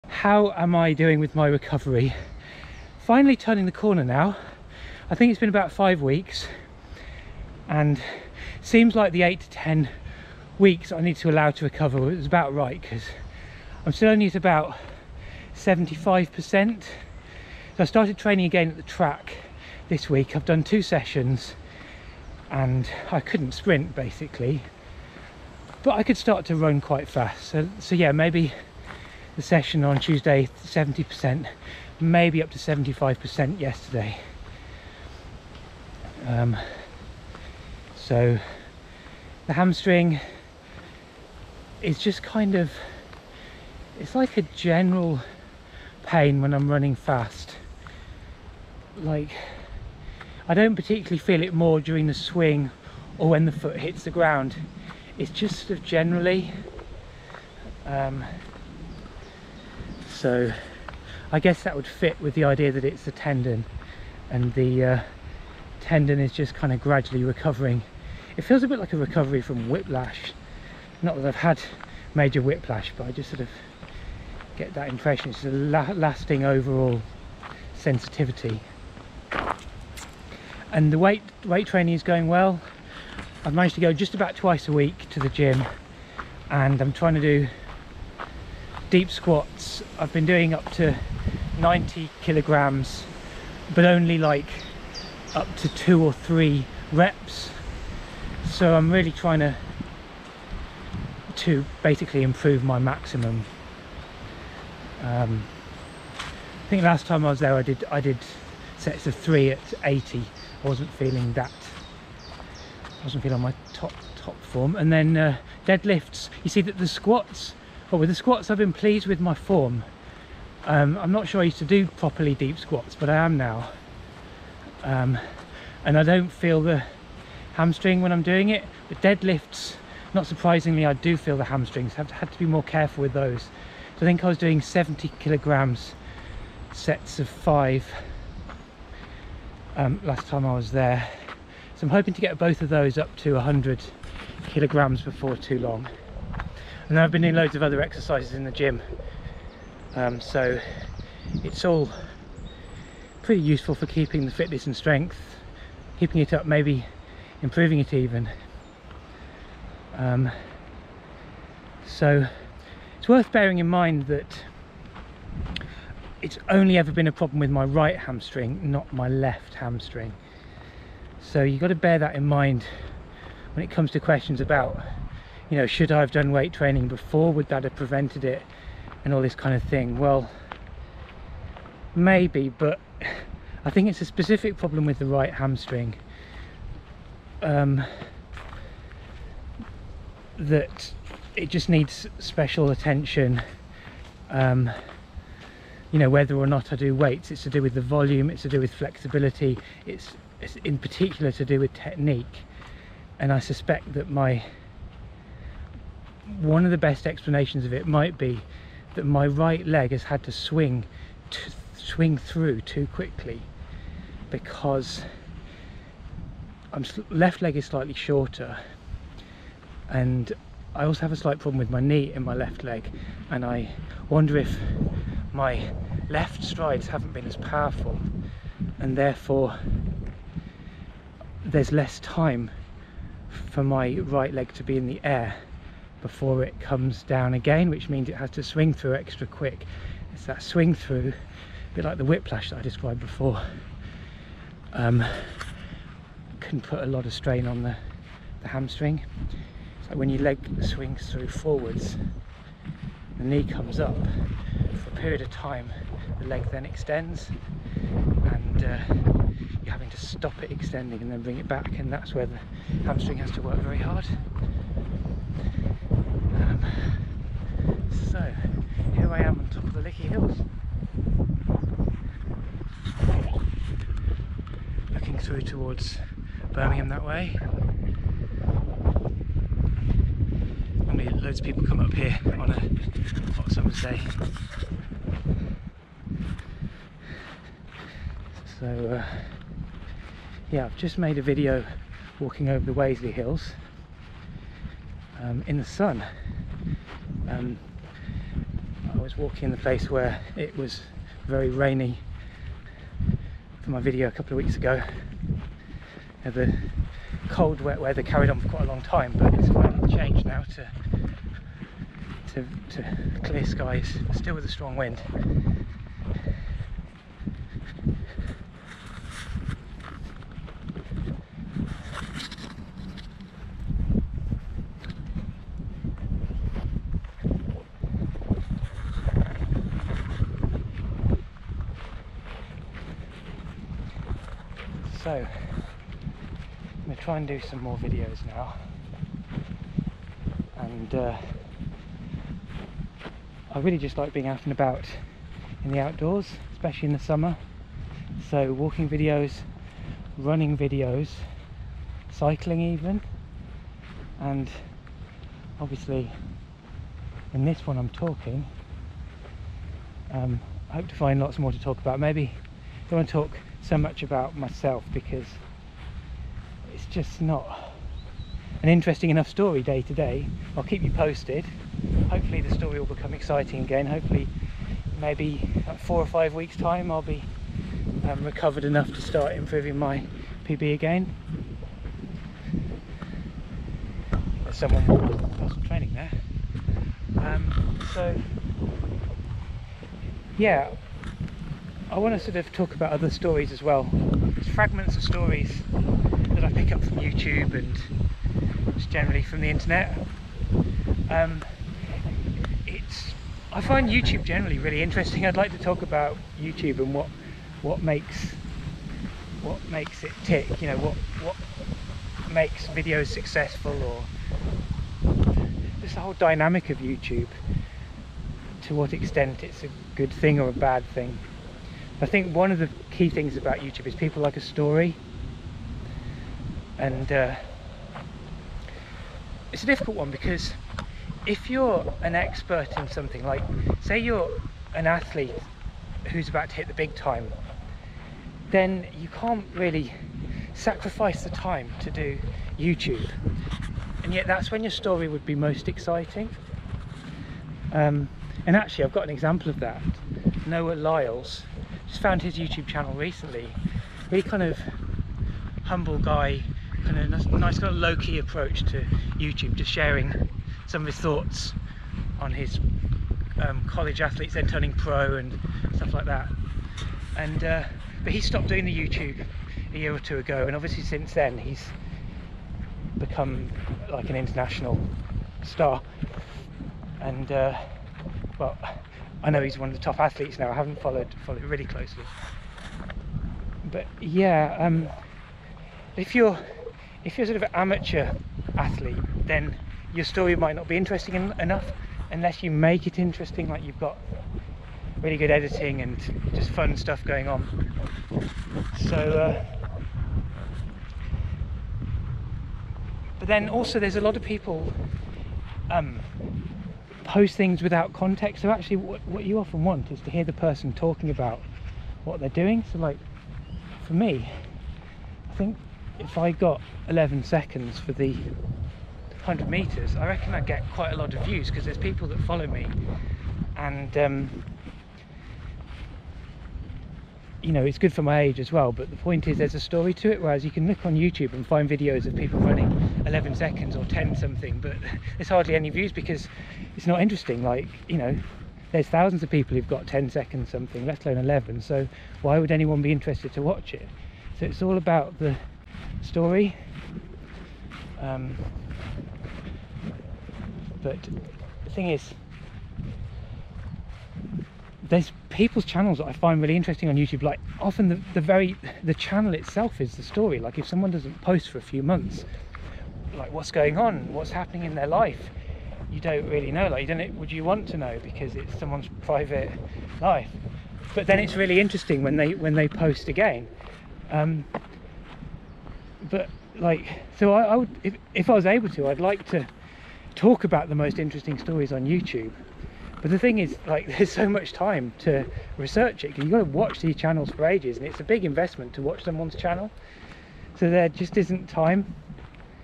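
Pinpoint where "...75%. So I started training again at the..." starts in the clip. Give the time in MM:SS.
00:15.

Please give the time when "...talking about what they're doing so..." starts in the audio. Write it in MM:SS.
08:30.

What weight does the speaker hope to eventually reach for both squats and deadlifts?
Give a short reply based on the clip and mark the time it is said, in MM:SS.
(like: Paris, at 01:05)
100 kg, at 02:23.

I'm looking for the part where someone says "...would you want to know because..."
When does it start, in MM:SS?
09:27.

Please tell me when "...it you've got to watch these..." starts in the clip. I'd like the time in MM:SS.
09:46.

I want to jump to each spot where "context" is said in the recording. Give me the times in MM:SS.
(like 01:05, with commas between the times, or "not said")
08:27.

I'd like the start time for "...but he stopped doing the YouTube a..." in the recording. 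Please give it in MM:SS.
07:48.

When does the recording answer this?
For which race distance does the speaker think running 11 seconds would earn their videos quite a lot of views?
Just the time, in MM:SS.
08:38.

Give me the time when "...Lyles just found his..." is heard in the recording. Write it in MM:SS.
07:30.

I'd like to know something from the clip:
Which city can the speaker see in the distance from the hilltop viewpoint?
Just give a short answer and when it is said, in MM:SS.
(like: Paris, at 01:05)
Birmingham, at 04:36.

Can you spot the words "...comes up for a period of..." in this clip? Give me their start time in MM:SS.
04:13.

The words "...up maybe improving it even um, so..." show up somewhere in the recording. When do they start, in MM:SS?
02:36.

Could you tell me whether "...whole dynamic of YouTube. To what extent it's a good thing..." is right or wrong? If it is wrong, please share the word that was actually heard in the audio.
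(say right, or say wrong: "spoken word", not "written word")
right.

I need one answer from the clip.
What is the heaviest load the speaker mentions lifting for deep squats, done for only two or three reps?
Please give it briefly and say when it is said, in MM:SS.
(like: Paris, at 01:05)
90 kg, at 01:31.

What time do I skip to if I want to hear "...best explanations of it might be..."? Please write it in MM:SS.
03:26.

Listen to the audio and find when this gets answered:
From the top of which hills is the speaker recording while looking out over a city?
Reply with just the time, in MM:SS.
04:29.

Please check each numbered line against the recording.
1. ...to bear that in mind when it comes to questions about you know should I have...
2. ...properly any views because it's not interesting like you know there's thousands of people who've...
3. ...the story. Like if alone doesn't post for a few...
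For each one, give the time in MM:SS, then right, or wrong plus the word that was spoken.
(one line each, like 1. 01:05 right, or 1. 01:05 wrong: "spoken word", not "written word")
1. 02:51 right
2. 08:55 wrong: "hardly", not "properly"
3. 09:19 wrong: "someone", not "alone".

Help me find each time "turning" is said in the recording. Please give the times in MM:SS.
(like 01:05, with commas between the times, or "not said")
00:03, 07:44.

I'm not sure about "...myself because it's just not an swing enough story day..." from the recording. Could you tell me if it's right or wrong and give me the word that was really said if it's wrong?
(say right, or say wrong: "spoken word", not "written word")
wrong: "interesting", not "swing".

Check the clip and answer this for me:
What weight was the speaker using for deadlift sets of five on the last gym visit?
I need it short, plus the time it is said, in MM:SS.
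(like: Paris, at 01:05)
70 kg, at 02:14.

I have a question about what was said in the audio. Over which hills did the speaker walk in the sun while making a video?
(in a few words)
Waseley Hills.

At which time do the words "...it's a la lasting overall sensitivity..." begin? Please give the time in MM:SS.
01:15.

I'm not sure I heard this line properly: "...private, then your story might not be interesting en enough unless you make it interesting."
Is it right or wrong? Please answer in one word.
wrong.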